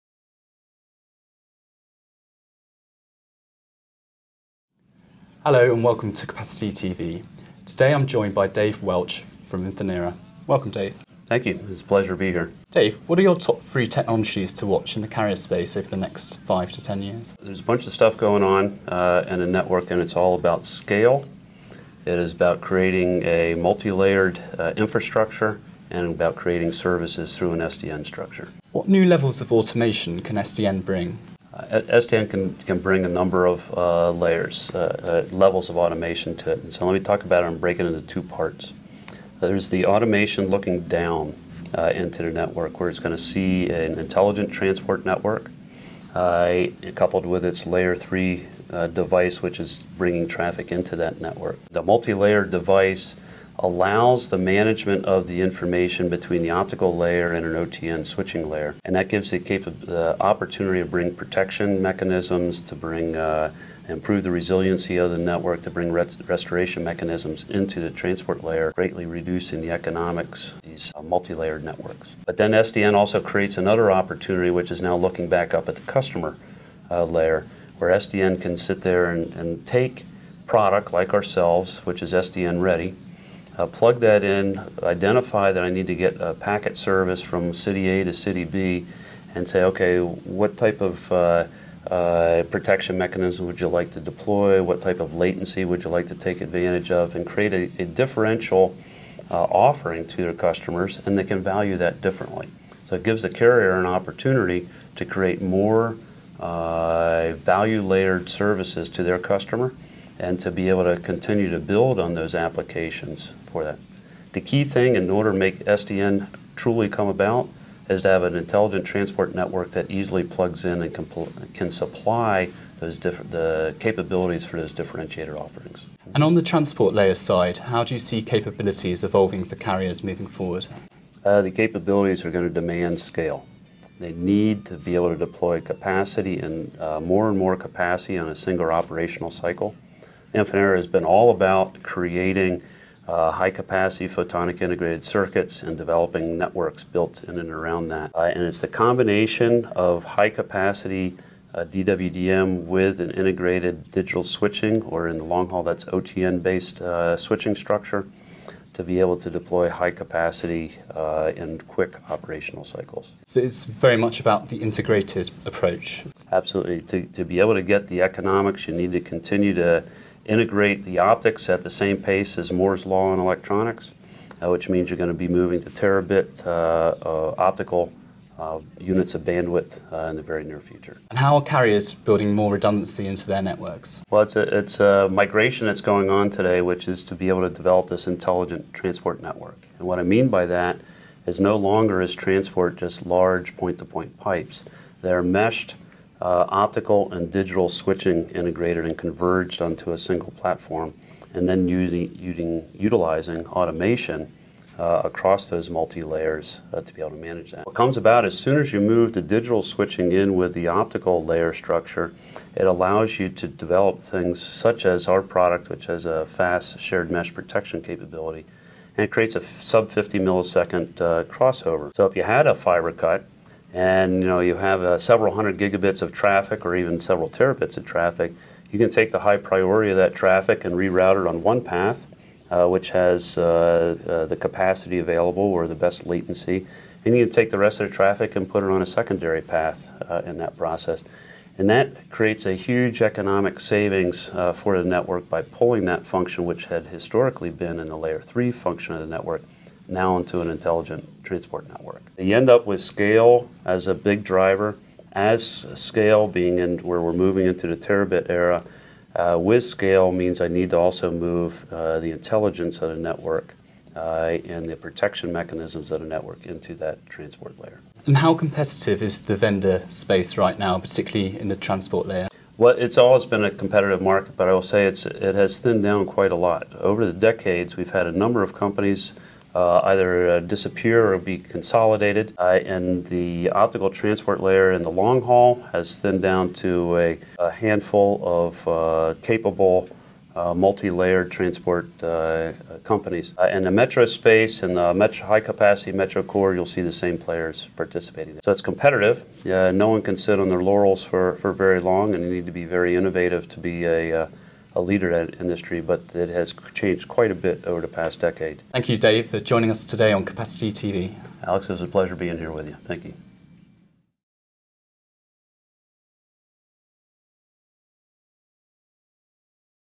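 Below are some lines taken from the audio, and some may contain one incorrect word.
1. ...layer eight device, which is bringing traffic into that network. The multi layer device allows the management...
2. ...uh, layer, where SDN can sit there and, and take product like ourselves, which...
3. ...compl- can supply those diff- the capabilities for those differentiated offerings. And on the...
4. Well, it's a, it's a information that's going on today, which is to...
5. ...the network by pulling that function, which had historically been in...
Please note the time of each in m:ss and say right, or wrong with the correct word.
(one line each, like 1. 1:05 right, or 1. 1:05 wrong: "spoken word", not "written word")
1. 0:47 wrong: "three", not "eight"
2. 1:16 right
3. 2:00 right
4. 3:04 wrong: "migration", not "information"
5. 4:04 right.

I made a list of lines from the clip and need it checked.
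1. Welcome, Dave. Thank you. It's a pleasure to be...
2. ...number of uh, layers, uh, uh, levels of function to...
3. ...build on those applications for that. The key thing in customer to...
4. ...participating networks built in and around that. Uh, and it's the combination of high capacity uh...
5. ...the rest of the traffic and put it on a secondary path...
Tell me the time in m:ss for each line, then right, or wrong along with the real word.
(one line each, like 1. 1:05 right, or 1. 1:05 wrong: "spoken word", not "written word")
1. 0:10 right
2. 0:33 wrong: "automation", not "function"
3. 1:51 wrong: "order", not "customer"
4. 2:25 wrong: "developing", not "participating"
5. 3:57 right.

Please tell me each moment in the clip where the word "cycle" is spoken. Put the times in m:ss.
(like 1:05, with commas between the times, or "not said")
2:19, 2:42.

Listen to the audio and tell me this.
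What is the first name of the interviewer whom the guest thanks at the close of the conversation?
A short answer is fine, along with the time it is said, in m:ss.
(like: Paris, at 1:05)
Alex, at 5:11.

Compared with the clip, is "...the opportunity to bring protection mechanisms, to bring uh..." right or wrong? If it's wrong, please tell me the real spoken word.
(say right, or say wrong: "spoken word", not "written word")
right.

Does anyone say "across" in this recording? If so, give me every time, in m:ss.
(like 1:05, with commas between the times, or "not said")
3:25.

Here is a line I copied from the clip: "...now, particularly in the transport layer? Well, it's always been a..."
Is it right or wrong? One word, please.
right.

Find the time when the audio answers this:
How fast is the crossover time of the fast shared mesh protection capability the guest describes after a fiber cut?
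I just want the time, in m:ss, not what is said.
3:39.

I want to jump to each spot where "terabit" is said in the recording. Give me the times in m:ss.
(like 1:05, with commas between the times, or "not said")
2:55, 3:47, 4:17.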